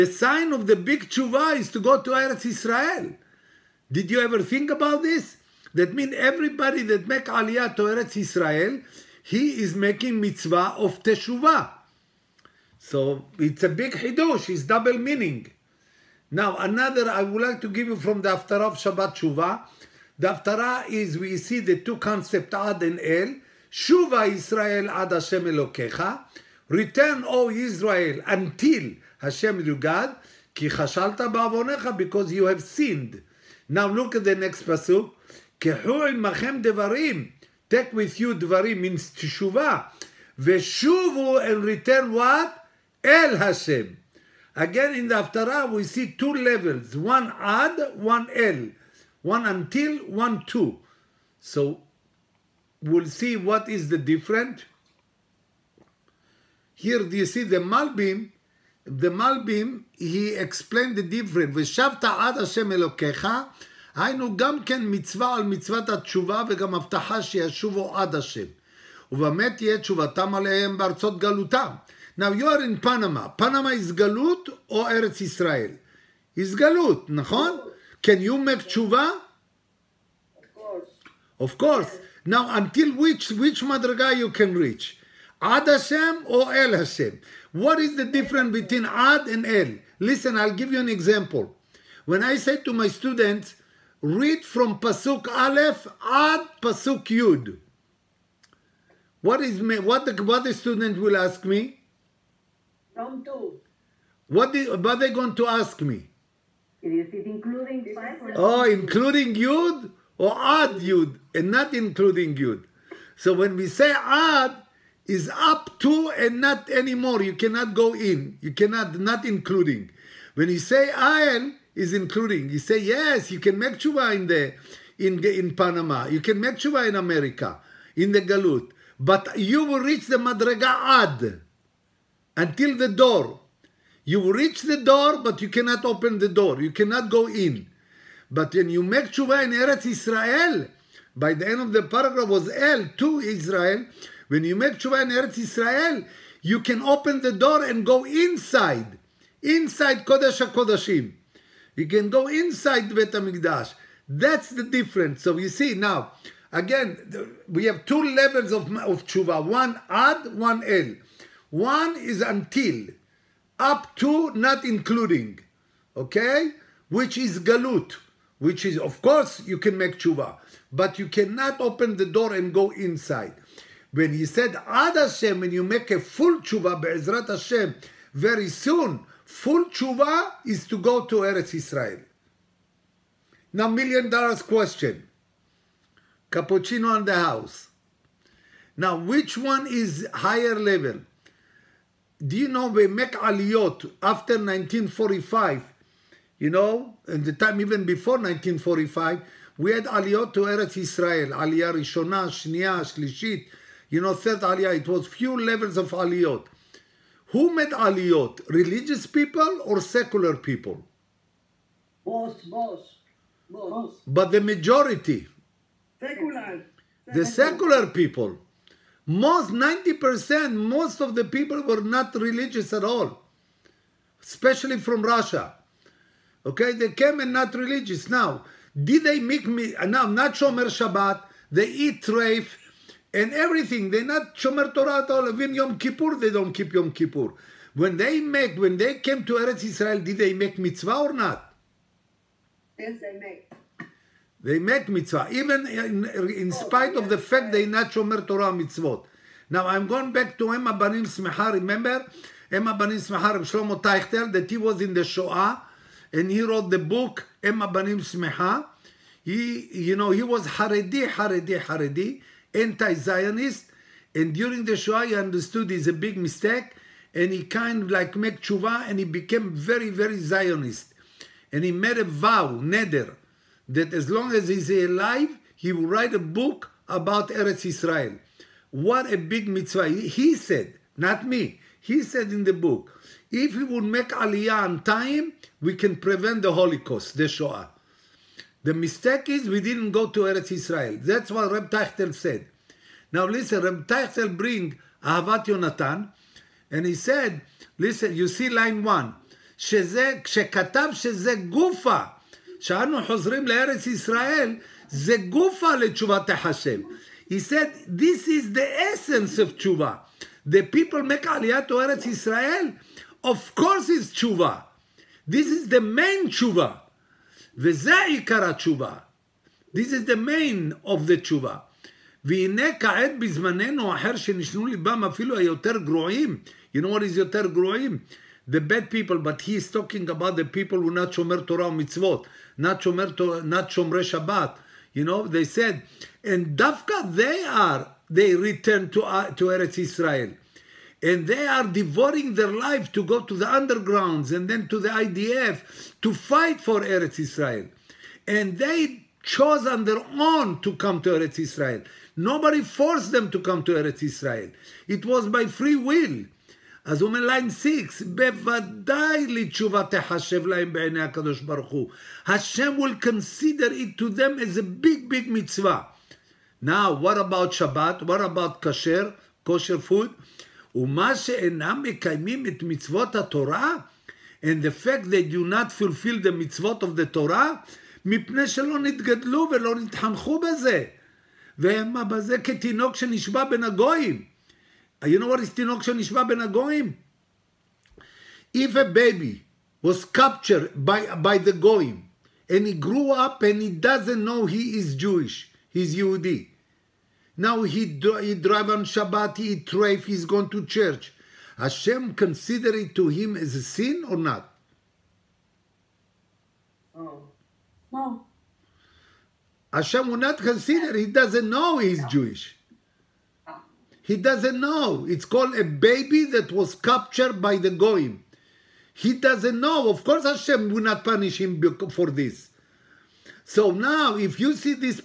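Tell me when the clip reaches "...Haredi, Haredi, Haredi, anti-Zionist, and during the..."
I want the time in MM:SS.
04:20.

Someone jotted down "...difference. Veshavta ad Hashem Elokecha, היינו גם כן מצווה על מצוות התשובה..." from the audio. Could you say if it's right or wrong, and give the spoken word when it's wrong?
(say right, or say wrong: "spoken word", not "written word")
right.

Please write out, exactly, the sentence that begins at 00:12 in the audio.
So it's a big hidosh, it's double meaning.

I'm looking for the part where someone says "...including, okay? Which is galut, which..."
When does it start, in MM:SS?
02:44.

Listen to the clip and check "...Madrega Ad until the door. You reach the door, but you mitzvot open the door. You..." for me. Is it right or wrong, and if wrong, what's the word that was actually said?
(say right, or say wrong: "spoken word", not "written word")
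wrong: "cannot", not "mitzvot".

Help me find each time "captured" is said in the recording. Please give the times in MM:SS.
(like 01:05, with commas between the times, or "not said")
06:30, 06:56.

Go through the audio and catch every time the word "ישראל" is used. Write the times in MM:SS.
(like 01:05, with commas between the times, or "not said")
05:03, 05:12.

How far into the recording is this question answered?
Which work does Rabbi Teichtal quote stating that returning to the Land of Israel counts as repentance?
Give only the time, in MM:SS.
04:55.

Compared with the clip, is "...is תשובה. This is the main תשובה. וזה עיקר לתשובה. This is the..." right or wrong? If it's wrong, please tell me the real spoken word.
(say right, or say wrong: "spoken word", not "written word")
wrong: "התשובה", not "לתשובה".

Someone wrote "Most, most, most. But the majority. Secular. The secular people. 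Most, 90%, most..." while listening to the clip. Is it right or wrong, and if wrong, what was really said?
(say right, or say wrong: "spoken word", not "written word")
right.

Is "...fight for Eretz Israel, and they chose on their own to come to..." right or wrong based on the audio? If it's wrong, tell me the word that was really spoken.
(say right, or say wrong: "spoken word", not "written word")
right.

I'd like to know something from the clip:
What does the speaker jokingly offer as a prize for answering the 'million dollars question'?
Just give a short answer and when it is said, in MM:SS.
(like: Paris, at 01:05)
Cappuccino, at 03:06.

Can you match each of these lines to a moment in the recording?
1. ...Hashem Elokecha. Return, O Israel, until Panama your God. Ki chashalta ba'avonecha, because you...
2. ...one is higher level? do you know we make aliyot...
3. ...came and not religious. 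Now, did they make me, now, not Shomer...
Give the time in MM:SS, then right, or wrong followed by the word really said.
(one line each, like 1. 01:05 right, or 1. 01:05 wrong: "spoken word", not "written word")
1. 00:25 wrong: "Hashem", not "Panama"
2. 03:09 right
3. 03:46 right.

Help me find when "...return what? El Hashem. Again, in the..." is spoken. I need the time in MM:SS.
00:41.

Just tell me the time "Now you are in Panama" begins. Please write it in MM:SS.
01:12.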